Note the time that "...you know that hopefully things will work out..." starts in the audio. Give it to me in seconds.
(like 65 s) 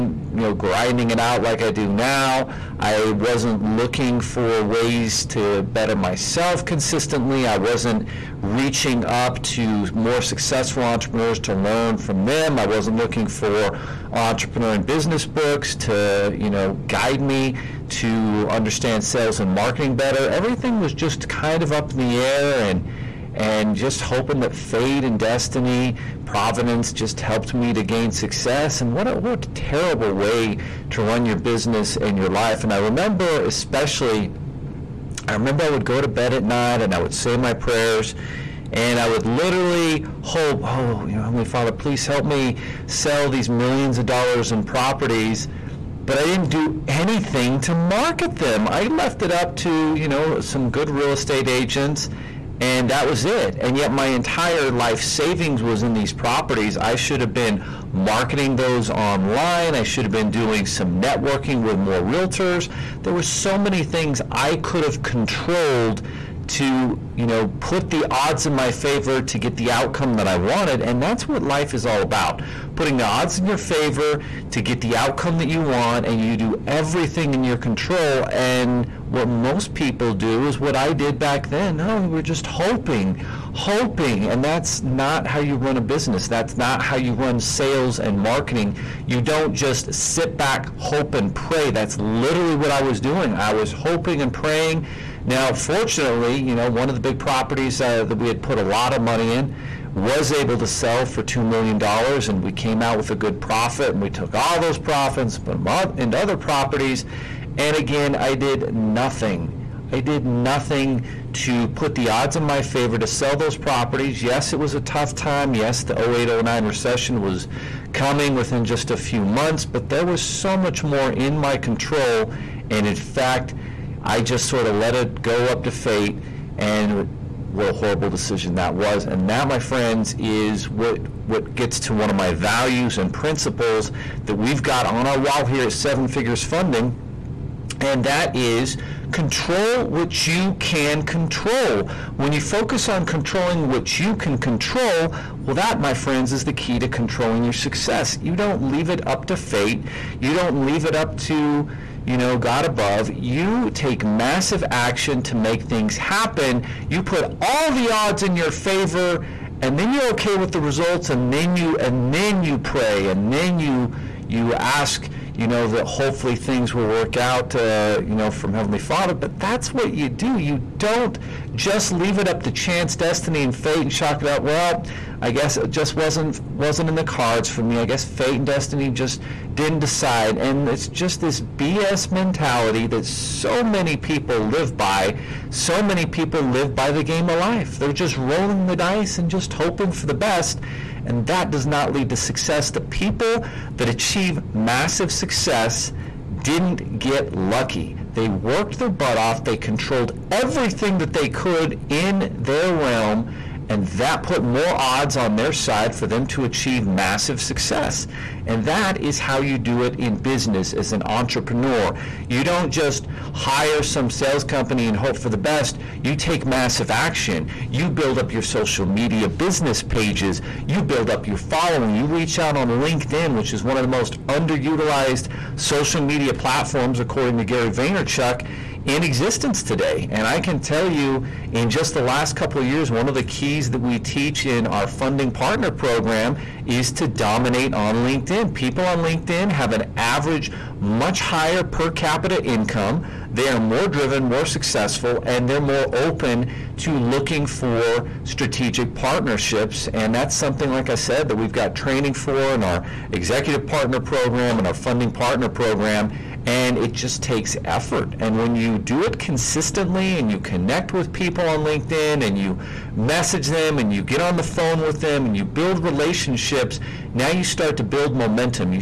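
165 s.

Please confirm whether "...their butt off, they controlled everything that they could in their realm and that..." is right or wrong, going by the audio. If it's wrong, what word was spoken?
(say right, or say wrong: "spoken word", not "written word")
right.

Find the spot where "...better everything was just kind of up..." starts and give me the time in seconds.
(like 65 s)
19 s.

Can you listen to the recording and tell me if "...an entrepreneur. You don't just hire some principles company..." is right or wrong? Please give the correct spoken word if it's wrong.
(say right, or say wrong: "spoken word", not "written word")
wrong: "sales", not "principles".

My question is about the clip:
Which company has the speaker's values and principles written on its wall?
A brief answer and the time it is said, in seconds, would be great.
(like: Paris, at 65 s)
Seven Figures Funding, at 135 s.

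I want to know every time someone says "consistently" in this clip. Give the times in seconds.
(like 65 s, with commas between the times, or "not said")
6 s, 259 s.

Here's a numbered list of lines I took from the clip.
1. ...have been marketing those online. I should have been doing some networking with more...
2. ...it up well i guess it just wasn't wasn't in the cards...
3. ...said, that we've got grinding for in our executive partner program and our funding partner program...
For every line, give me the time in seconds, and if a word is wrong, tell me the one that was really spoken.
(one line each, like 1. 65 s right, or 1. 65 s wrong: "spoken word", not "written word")
1. 57 s right
2. 174 s right
3. 250 s wrong: "training", not "grinding".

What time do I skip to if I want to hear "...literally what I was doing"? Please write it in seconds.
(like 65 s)
91 s.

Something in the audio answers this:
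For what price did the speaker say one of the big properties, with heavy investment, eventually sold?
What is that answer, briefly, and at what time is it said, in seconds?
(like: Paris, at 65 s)
$2 million, at 101 s.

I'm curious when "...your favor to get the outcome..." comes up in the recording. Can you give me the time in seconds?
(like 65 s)
73 s.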